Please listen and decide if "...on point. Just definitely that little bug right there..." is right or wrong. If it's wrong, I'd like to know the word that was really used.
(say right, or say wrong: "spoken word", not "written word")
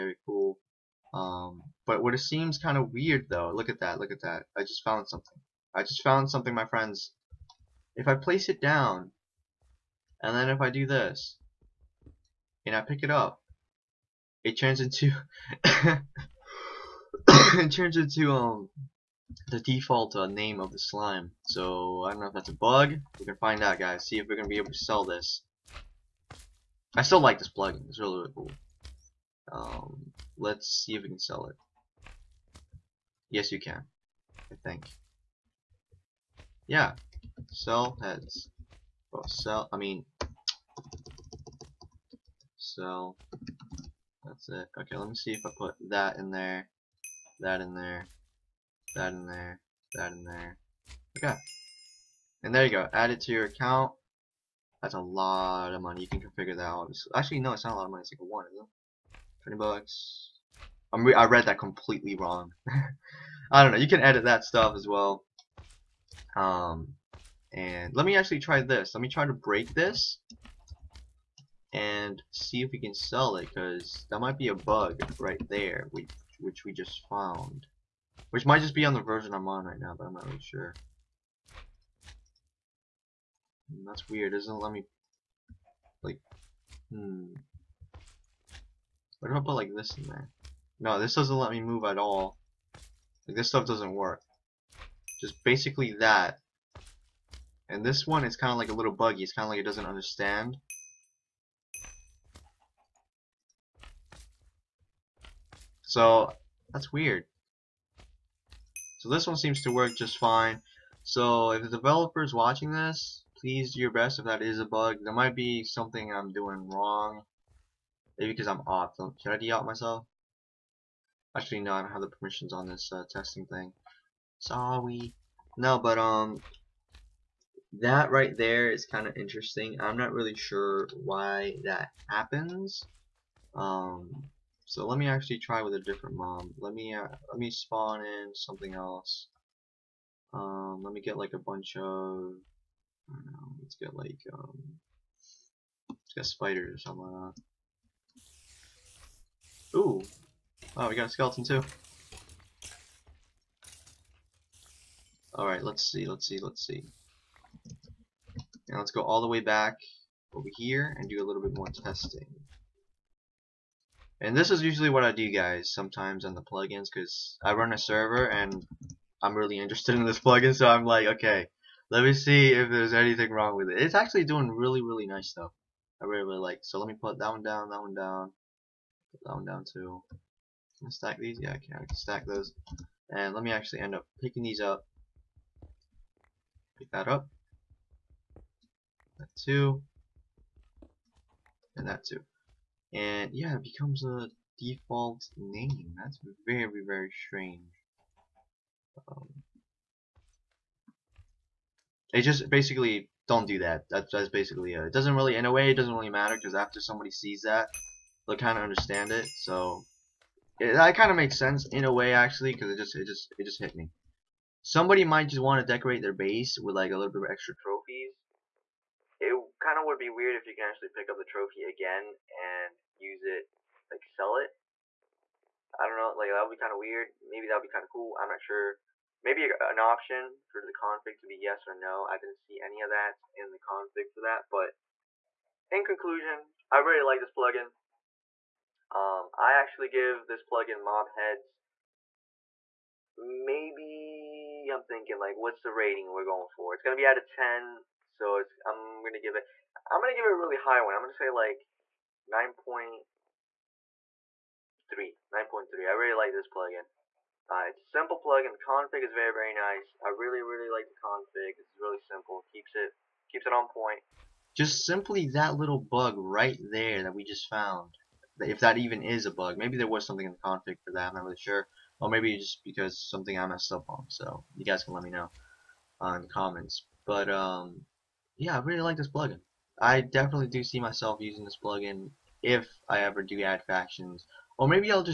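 wrong: "simply", not "definitely".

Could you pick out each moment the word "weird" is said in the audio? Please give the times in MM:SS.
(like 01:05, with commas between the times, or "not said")
00:02, 01:24, 01:46, 03:40, 03:46.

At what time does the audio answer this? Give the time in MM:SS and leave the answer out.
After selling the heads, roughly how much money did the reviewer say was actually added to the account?
00:59.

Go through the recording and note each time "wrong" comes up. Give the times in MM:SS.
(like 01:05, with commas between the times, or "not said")
01:02, 01:56, 02:53.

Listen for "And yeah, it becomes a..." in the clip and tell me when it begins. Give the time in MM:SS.
03:12.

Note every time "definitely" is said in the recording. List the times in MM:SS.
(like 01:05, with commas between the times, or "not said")
04:39.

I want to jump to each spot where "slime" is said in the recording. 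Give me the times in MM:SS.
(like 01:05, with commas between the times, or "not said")
00:20.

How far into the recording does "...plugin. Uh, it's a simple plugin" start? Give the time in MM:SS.
04:16.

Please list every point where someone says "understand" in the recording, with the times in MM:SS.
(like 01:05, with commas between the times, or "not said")
01:39, 03:28.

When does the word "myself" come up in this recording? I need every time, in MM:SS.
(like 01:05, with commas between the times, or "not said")
01:59, 04:40.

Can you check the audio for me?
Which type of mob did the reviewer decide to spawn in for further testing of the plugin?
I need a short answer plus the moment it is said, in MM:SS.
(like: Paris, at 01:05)
spiders, at 02:26.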